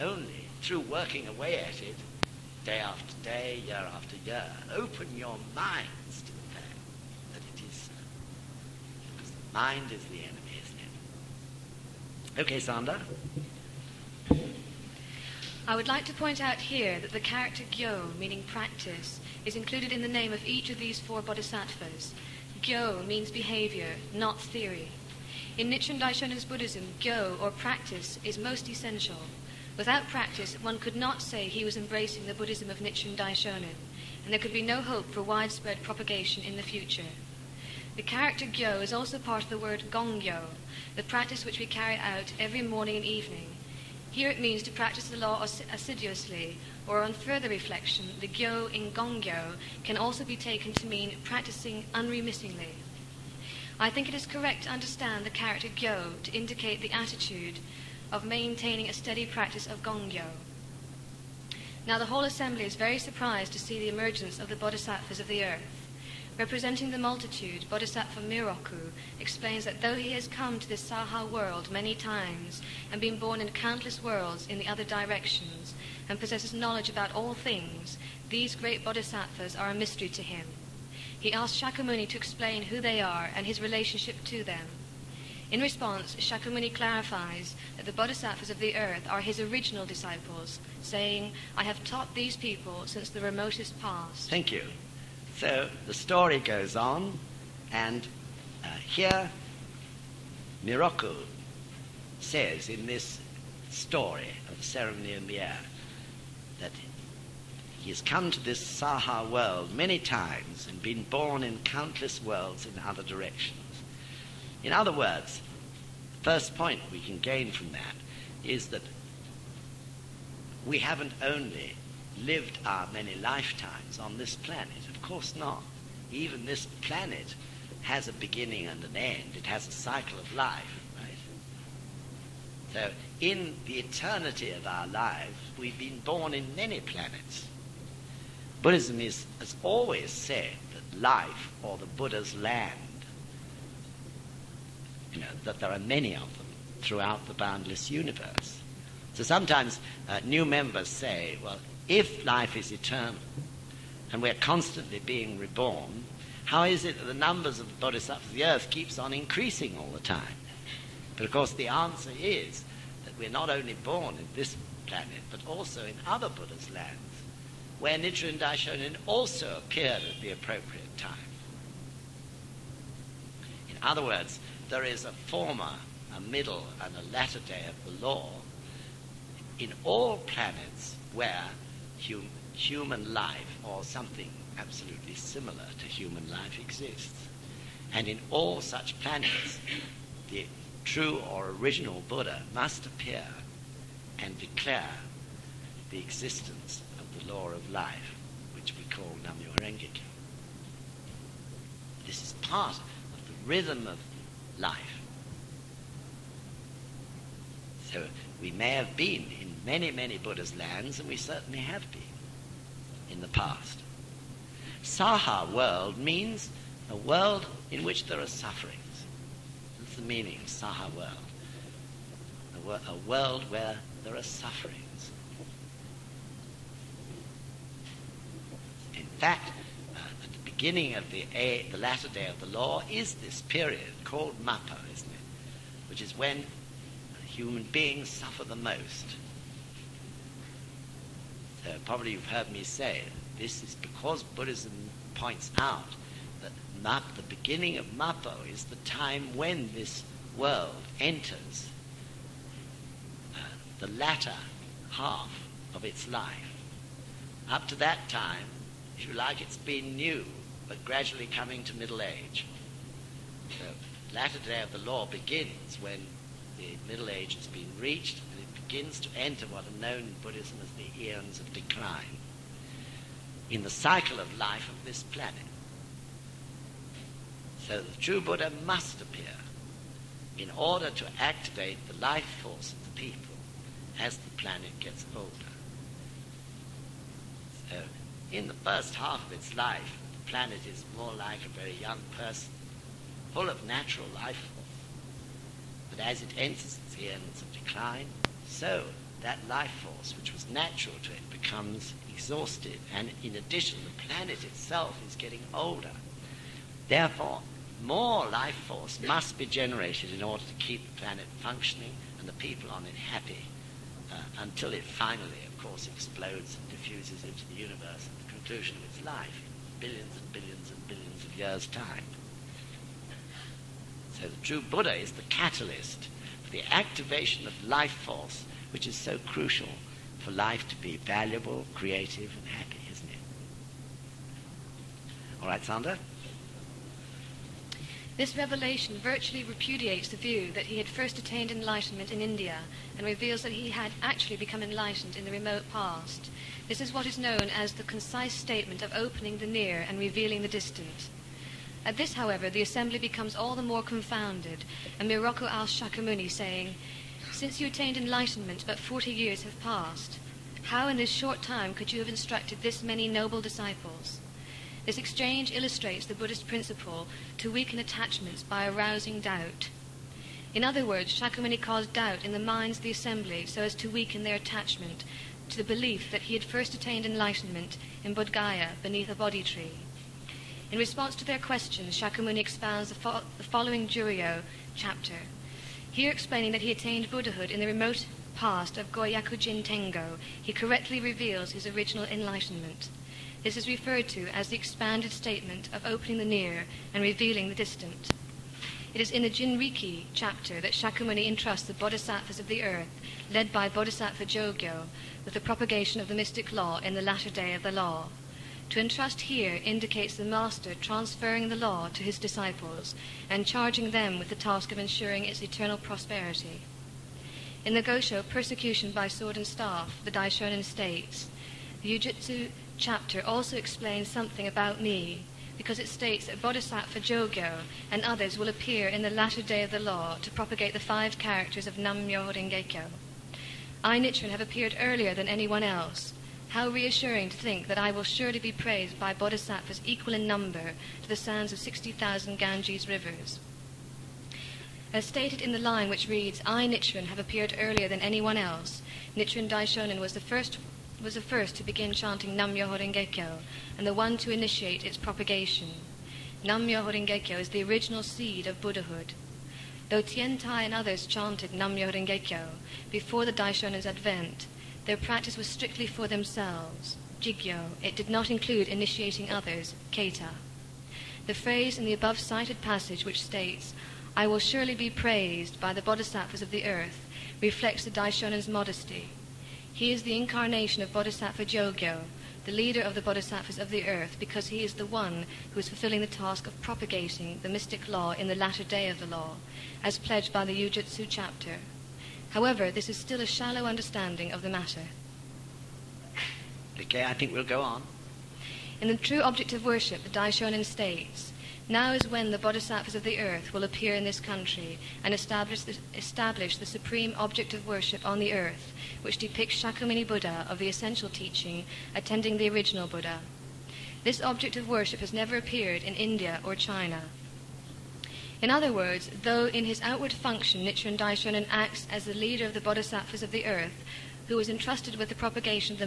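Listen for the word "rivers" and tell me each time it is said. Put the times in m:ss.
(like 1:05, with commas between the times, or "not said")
7:22.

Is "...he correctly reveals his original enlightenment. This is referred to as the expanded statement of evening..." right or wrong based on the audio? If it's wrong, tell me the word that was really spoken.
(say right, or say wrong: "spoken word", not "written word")
wrong: "opening", not "evening".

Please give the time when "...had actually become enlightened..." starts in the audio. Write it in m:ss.
5:43.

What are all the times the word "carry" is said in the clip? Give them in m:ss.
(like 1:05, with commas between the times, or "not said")
0:41.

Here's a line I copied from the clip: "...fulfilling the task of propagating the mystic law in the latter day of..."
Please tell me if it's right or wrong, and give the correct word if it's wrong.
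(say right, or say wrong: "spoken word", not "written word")
right.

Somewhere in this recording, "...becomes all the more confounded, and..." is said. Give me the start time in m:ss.
5:52.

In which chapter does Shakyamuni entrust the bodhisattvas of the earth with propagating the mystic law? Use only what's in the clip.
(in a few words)
Jinriki chapter.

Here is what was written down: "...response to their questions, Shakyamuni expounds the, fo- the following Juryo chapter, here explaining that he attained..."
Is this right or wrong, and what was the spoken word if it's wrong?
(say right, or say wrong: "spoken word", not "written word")
right.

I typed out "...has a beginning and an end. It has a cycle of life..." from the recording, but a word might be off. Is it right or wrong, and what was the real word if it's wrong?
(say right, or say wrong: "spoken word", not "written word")
right.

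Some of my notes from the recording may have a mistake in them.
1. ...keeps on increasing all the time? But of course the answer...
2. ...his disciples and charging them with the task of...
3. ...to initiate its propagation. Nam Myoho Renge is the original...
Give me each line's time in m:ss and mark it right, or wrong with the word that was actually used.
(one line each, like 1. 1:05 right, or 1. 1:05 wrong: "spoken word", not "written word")
1. 2:38 right
2. 6:52 right
3. 7:34 right.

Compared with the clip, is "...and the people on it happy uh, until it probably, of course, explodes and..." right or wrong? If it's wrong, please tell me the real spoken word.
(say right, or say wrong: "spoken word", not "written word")
wrong: "finally", not "probably".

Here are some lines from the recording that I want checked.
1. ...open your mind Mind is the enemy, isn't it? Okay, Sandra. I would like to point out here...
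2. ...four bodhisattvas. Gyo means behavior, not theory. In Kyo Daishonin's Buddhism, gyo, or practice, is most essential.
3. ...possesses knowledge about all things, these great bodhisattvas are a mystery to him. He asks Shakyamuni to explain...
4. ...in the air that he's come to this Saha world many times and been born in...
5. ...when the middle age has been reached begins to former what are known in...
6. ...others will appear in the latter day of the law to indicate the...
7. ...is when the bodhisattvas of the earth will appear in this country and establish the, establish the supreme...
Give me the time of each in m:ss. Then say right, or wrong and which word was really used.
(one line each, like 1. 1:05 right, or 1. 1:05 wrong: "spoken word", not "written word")
1. 0:04 right
2. 0:20 wrong: "Nichiren", not "Kyo"
3. 1:16 right
4. 1:45 right
5. 4:25 wrong: "enter", not "former"
6. 7:08 wrong: "propagate", not "indicate"
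7. 8:21 right.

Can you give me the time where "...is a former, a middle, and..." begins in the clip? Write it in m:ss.
2:54.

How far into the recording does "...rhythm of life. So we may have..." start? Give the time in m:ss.
3:23.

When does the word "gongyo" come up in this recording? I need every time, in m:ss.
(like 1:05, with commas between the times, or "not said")
0:39, 0:48, 0:59.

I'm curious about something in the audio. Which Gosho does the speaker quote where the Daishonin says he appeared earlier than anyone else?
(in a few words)
Persecution by Sword and Staff.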